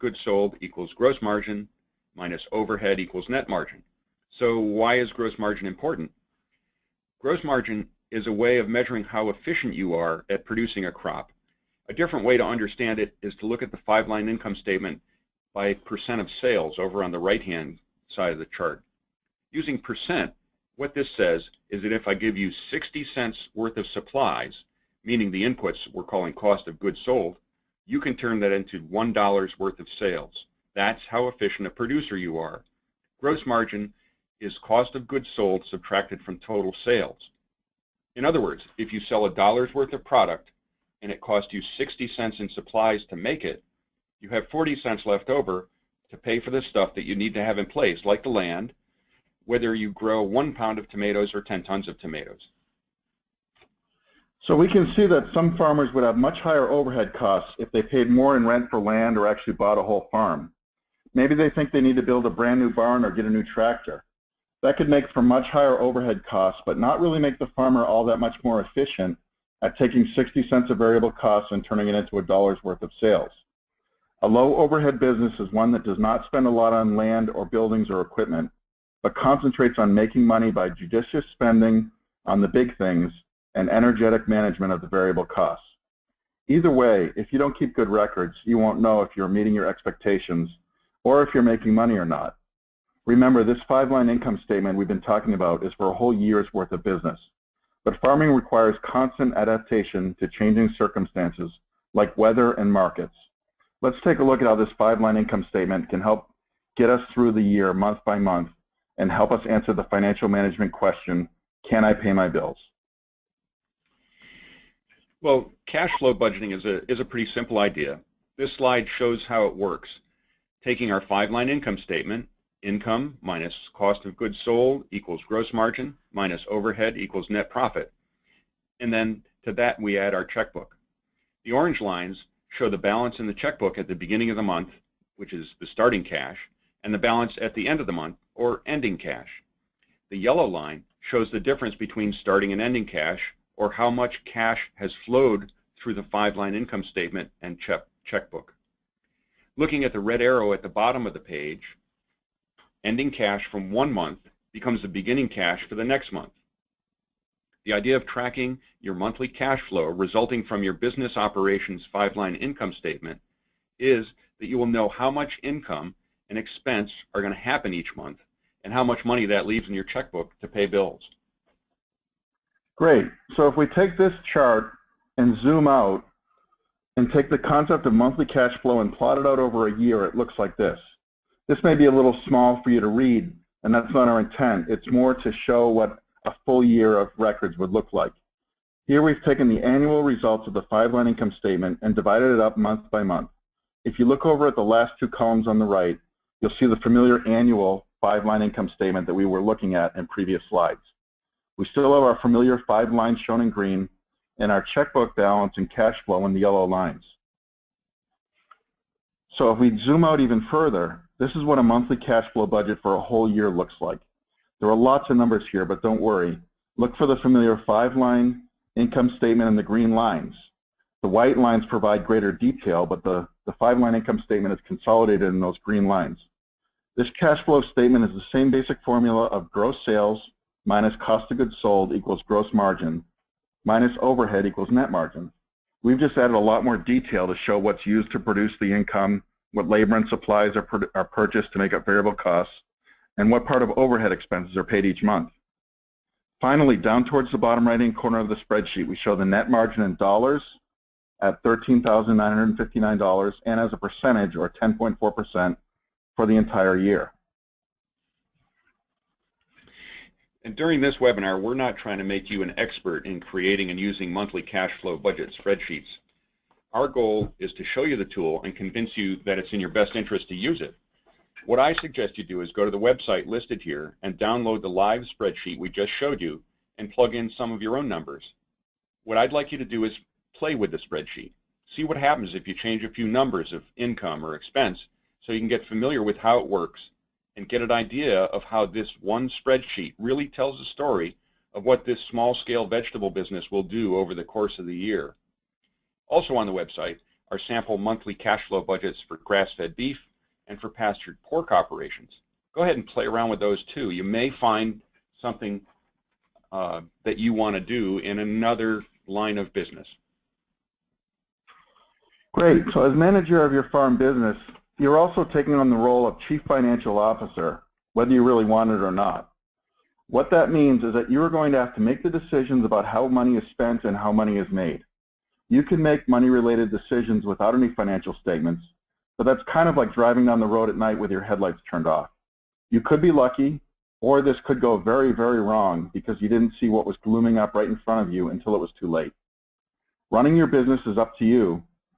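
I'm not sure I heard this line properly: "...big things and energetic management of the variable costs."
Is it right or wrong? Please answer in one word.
right.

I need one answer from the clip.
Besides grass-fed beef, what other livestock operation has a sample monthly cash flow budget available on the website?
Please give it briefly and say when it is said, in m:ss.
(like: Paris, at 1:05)
pastured pork, at 5:00.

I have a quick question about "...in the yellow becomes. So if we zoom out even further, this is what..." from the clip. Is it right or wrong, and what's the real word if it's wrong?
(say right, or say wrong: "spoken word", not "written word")
wrong: "lines", not "becomes".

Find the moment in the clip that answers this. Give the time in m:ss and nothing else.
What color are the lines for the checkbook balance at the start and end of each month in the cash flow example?
2:11.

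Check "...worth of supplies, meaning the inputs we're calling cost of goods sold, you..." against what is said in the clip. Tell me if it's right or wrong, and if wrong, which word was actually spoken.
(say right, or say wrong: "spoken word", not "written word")
right.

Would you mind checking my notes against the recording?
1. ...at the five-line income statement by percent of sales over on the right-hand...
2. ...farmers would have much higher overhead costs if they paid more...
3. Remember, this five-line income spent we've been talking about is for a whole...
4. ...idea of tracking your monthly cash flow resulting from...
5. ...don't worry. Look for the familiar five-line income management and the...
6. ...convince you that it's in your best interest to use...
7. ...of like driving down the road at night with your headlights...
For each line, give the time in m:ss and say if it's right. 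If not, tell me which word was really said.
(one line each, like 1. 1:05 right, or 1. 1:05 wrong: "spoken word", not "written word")
1. 0:13 right
2. 0:55 right
3. 1:33 wrong: "statement", not "spent"
4. 2:37 right
5. 3:35 wrong: "statement", not "management"
6. 4:28 right
7. 5:29 right.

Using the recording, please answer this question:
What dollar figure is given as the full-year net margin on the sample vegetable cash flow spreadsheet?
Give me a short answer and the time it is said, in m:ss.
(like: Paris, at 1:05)
$13,959, at 4:11.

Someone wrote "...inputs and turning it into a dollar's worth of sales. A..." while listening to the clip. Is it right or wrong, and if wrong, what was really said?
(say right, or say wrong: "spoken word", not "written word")
wrong: "costs", not "inputs".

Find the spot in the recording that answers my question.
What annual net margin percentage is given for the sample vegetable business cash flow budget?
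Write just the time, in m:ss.
4:14.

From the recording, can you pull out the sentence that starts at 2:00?
Taking our five-line income statement, income minus cost of goods sold equals gross margin minus overhead equals net profit.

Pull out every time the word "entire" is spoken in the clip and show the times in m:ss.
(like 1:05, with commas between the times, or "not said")
4:16.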